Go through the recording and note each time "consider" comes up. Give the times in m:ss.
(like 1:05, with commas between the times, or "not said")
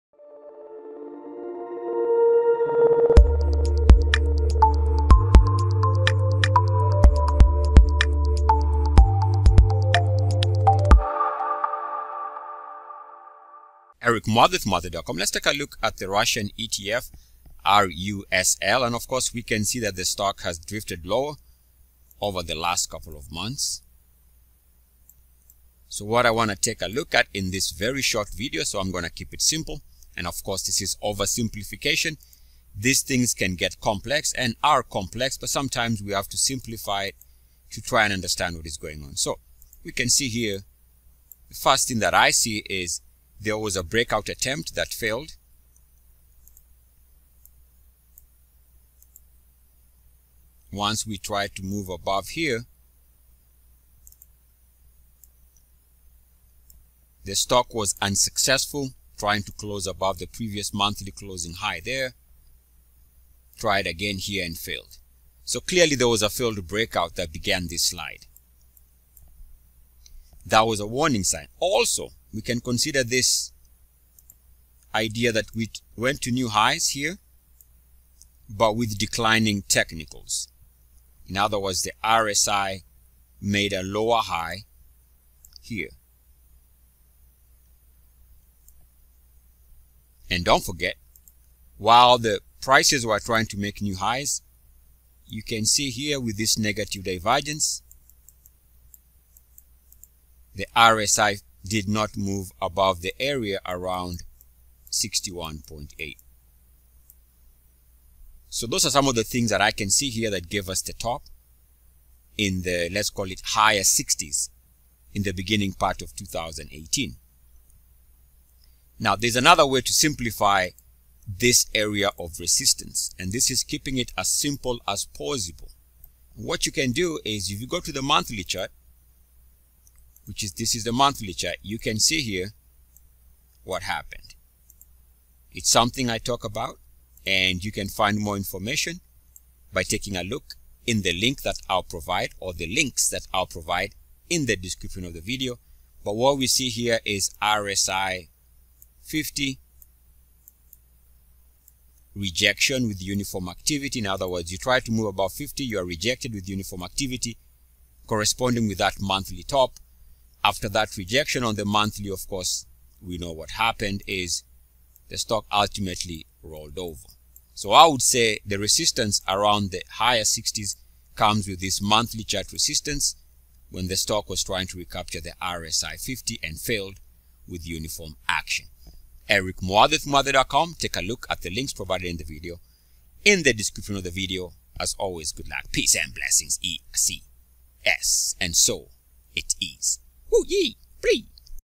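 1:12.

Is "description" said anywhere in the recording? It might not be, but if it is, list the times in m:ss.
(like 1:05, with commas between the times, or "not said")
2:24, 3:03.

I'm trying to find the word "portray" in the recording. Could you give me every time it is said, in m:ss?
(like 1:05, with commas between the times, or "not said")
not said.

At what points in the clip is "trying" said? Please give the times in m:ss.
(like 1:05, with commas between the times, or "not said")
0:59, 1:33, 2:54.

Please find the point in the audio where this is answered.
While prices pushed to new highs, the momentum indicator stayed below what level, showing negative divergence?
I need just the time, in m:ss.
1:44.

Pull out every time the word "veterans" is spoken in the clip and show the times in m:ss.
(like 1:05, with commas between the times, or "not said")
not said.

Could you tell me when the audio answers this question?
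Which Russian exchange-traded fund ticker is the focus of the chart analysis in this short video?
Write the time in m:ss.
0:17.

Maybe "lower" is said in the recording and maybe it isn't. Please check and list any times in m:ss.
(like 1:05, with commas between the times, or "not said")
0:21, 1:23.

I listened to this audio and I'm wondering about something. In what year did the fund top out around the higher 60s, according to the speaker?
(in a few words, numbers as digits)
2018.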